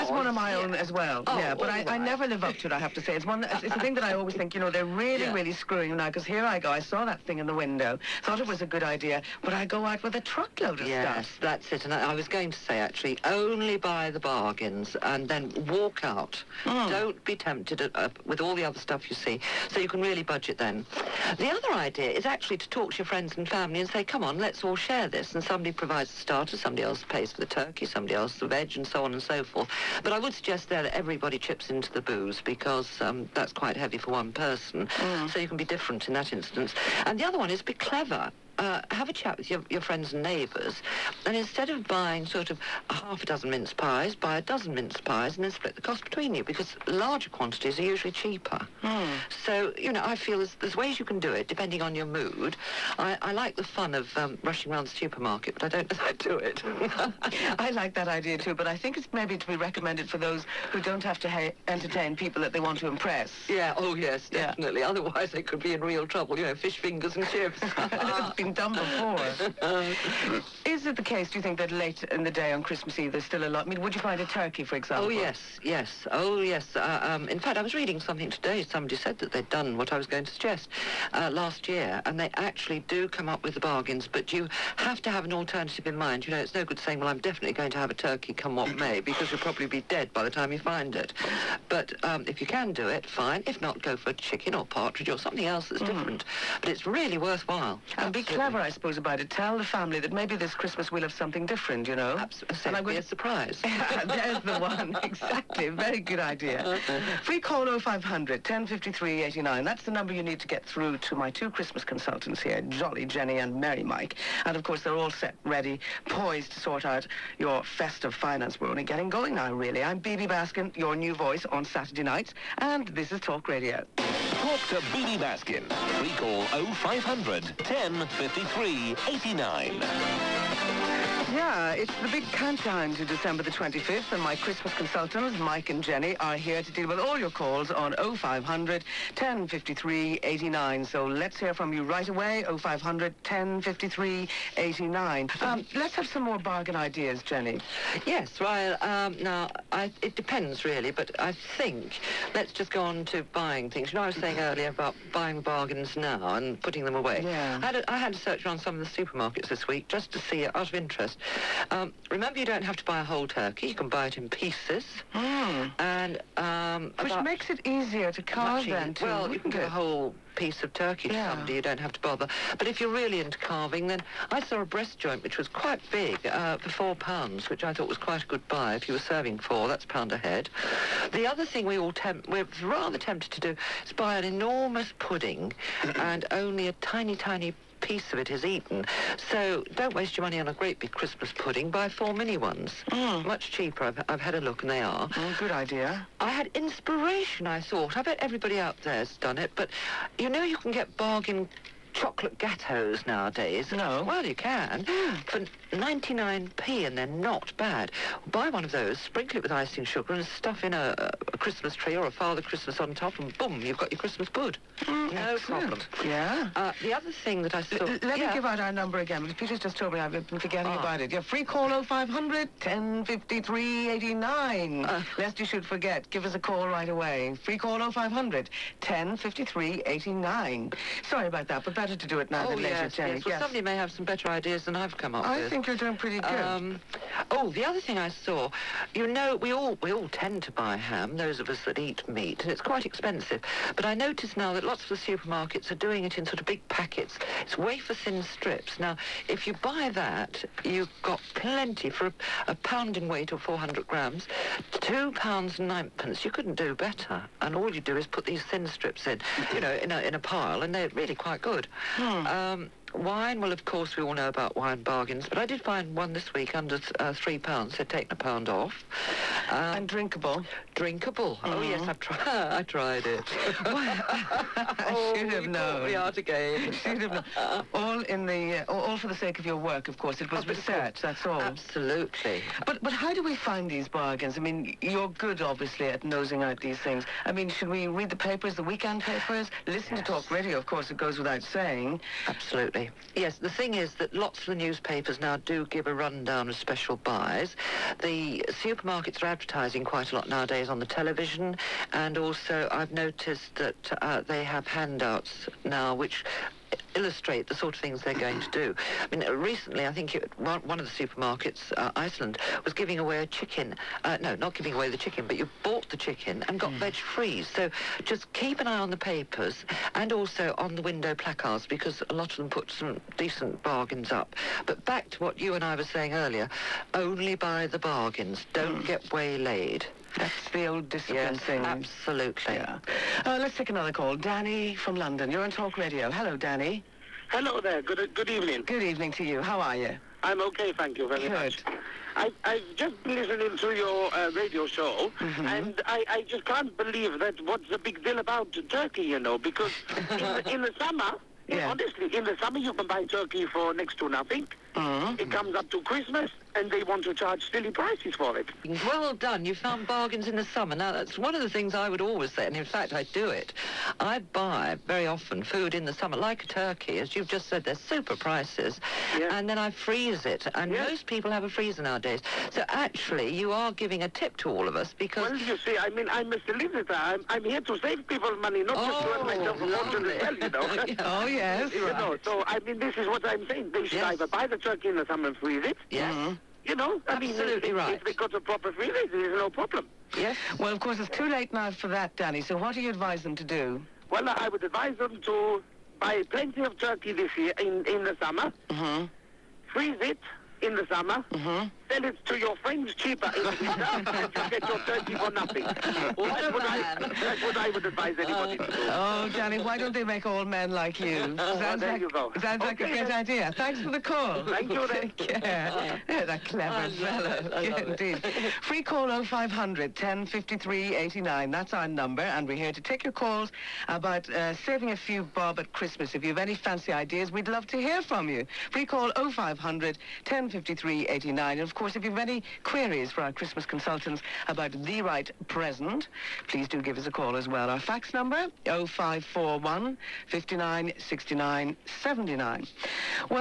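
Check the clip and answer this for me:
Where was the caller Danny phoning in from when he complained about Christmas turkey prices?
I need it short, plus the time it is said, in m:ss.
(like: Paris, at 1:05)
London, at 5:34.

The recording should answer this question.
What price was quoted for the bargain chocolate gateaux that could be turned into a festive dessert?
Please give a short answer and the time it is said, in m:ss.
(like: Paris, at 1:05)
99p, at 3:25.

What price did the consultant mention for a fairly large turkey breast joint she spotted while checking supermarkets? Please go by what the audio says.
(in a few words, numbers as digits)
£4.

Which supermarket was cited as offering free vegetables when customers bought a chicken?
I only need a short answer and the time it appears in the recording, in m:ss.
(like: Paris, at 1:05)
Iceland, at 5:11.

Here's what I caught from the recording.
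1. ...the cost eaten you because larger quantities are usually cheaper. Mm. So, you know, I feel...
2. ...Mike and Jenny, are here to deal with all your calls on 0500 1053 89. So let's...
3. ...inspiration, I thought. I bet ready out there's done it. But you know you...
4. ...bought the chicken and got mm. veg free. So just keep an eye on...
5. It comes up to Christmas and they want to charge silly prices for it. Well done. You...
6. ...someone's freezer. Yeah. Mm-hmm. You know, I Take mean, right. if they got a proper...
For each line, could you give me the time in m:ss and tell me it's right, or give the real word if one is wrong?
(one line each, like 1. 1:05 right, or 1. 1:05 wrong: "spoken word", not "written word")
1. 0:45 wrong: "between", not "eaten"
2. 2:15 right
3. 3:16 wrong: "everybody", not "ready"
4. 5:15 right
5. 5:55 right
6. 6:25 wrong: "Absolutely", not "Take".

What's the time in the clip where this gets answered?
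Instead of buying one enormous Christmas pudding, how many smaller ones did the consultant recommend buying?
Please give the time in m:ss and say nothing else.
3:11.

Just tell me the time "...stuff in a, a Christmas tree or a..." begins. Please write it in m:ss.
3:30.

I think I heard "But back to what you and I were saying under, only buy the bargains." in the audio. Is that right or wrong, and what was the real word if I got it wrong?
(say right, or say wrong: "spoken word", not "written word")
wrong: "earlier", not "under".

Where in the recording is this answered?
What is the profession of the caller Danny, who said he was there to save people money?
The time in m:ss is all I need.
6:16.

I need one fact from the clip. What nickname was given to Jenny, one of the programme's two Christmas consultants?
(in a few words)
Jolly Jenny.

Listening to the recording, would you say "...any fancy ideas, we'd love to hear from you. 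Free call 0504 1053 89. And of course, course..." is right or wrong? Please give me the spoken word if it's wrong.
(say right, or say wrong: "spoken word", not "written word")
wrong: "0500", not "0504".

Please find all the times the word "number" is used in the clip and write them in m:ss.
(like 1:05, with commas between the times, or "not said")
1:49, 3:38, 7:01, 7:18.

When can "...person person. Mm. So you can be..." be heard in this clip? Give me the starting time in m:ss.
0:34.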